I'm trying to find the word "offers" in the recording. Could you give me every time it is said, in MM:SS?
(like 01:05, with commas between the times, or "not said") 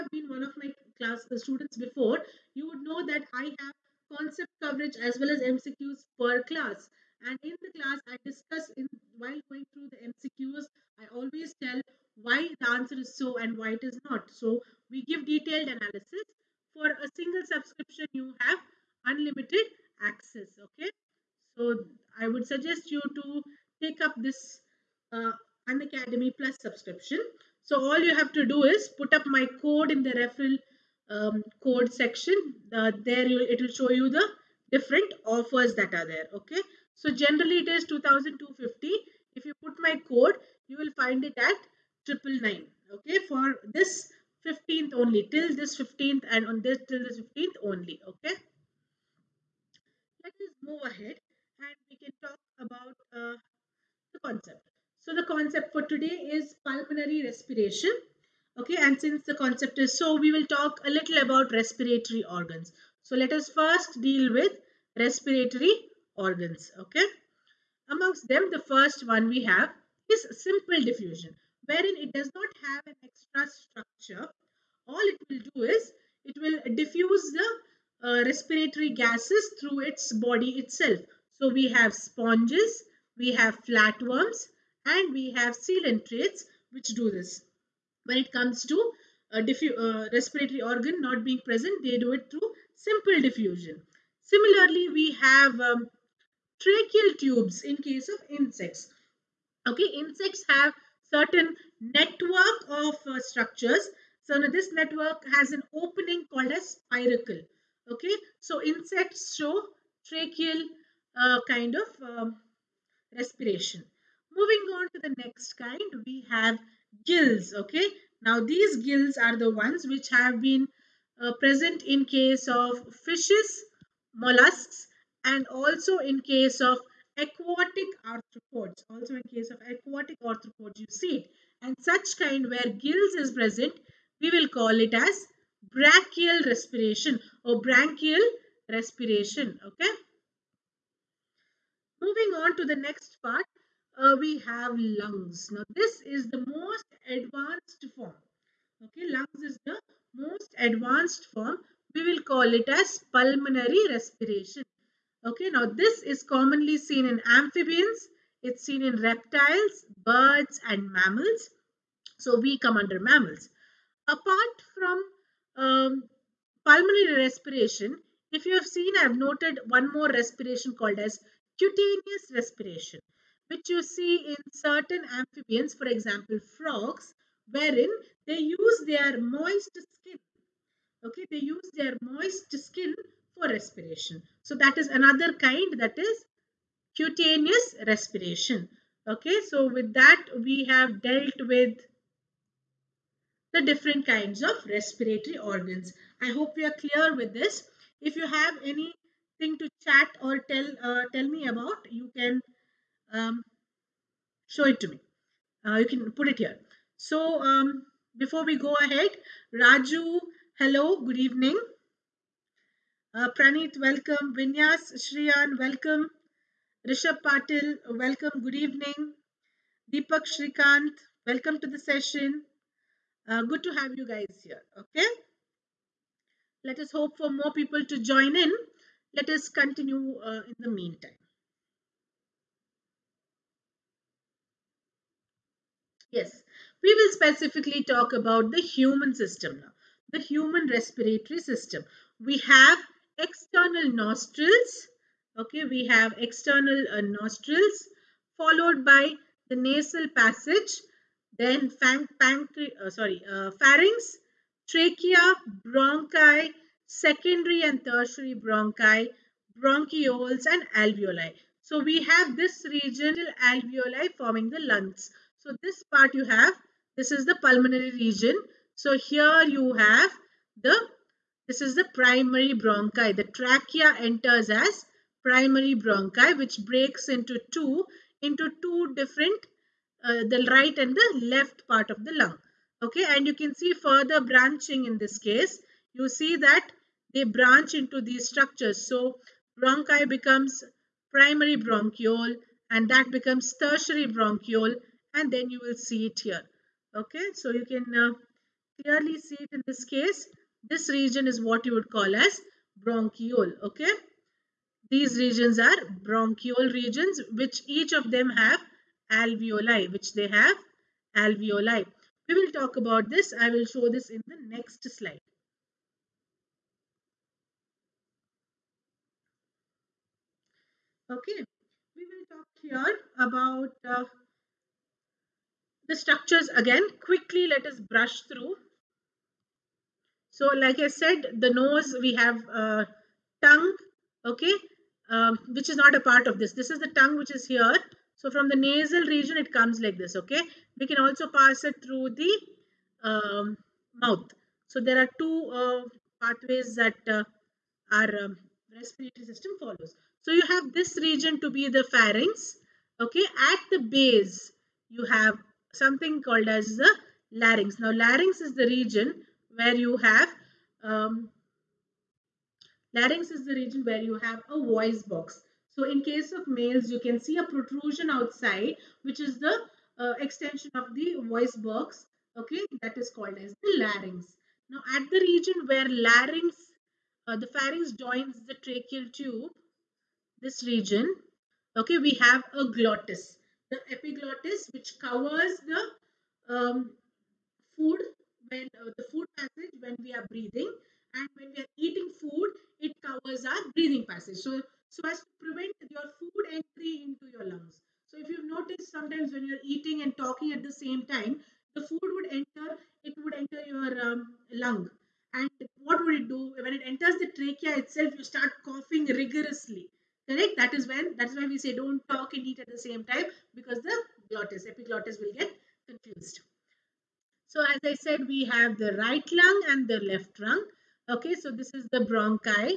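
00:35.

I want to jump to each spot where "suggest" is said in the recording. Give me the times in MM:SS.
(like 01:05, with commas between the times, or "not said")
00:22.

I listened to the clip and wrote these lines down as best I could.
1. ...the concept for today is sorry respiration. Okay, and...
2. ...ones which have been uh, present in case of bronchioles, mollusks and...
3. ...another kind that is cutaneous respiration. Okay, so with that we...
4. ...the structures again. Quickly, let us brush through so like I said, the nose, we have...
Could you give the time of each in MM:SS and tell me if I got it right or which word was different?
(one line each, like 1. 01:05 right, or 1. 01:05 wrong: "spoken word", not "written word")
1. 00:55 wrong: "pulmonary", not "sorry"
2. 01:59 wrong: "fishes", not "bronchioles"
3. 03:04 right
4. 05:25 right.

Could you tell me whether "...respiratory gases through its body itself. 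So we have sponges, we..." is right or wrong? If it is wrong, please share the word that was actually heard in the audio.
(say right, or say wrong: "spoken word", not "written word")
right.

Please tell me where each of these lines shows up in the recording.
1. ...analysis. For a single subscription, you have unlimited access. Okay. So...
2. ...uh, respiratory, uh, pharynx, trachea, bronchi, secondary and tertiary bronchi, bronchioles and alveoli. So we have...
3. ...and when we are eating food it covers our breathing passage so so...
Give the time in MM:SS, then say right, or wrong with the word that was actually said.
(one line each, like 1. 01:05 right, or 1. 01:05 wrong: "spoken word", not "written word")
1. 00:15 right
2. 04:12 wrong: "sorry", not "respiratory"
3. 06:31 right.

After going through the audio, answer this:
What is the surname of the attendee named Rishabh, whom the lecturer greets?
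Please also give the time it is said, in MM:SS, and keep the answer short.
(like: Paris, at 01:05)
Patil, at 03:37.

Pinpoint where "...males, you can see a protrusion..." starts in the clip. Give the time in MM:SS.
06:06.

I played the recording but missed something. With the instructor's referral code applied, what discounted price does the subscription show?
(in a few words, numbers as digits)
999.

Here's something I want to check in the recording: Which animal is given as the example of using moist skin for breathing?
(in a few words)
frogs.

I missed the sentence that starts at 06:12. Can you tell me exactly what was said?
Okay, that is called as the larynx.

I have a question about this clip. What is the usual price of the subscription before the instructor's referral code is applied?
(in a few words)
2250.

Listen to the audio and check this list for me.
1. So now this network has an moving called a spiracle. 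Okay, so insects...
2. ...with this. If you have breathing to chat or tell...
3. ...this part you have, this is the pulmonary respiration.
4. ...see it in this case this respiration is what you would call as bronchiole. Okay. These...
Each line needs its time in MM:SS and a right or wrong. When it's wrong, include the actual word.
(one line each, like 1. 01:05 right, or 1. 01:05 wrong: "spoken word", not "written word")
1. 01:44 wrong: "opening", not "moving"
2. 03:17 wrong: "anything", not "breathing"
3. 04:25 wrong: "region", not "respiration"
4. 04:59 wrong: "region", not "respiration".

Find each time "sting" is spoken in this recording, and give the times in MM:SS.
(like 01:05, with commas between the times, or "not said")
not said.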